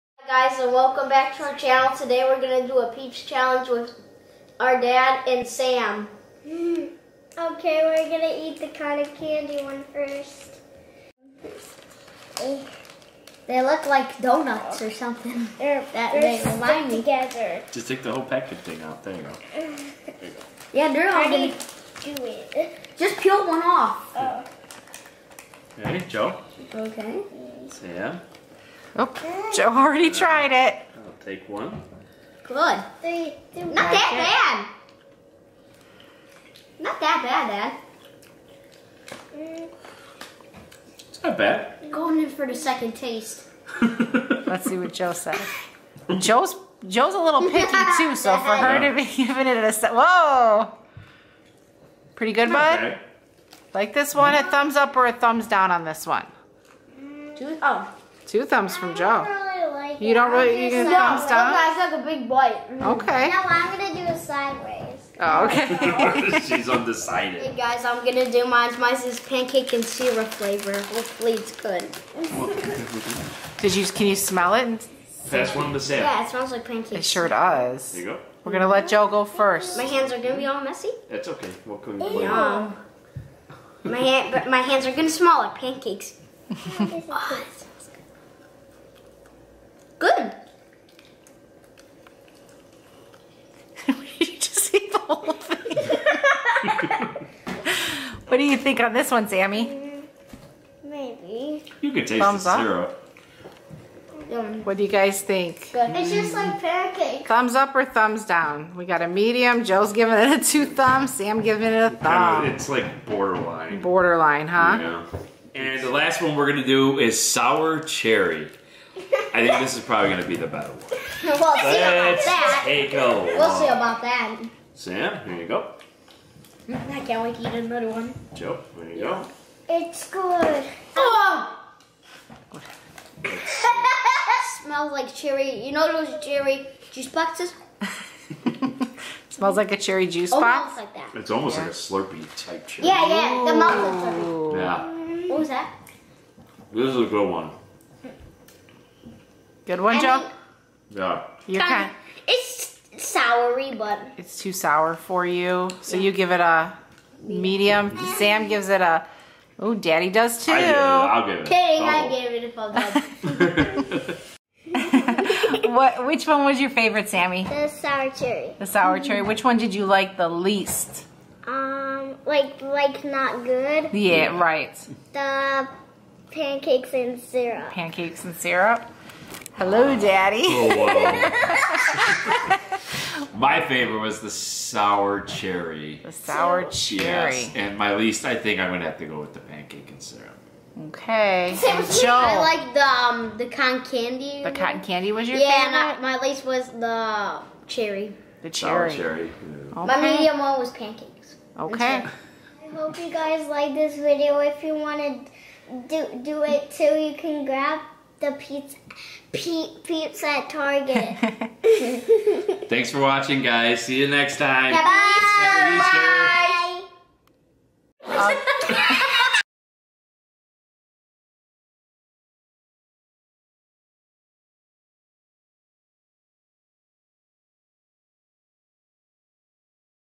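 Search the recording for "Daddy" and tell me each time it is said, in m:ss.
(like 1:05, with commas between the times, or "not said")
2:39, 2:59.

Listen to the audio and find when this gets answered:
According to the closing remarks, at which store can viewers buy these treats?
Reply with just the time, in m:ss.
3:30.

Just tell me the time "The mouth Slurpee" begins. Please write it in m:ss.
2:23.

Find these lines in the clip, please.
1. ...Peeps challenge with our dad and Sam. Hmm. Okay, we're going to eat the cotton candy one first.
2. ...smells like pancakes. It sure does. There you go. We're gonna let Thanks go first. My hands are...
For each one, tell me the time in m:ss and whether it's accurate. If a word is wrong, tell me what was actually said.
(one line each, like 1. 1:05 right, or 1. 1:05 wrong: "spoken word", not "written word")
1. 0:02 right
2. 1:16 wrong: "Joe", not "Thanks".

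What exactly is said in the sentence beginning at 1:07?
Hey guys, I'm going to do mine.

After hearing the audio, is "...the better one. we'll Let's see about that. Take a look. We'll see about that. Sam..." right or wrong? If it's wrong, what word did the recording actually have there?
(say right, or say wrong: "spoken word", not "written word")
right.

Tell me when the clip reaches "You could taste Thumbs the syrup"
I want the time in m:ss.
1:41.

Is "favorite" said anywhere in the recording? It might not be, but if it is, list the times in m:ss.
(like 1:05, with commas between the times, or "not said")
2:46, 3:03, 3:15.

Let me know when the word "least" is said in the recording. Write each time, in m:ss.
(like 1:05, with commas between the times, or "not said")
2:50, 3:07, 3:16.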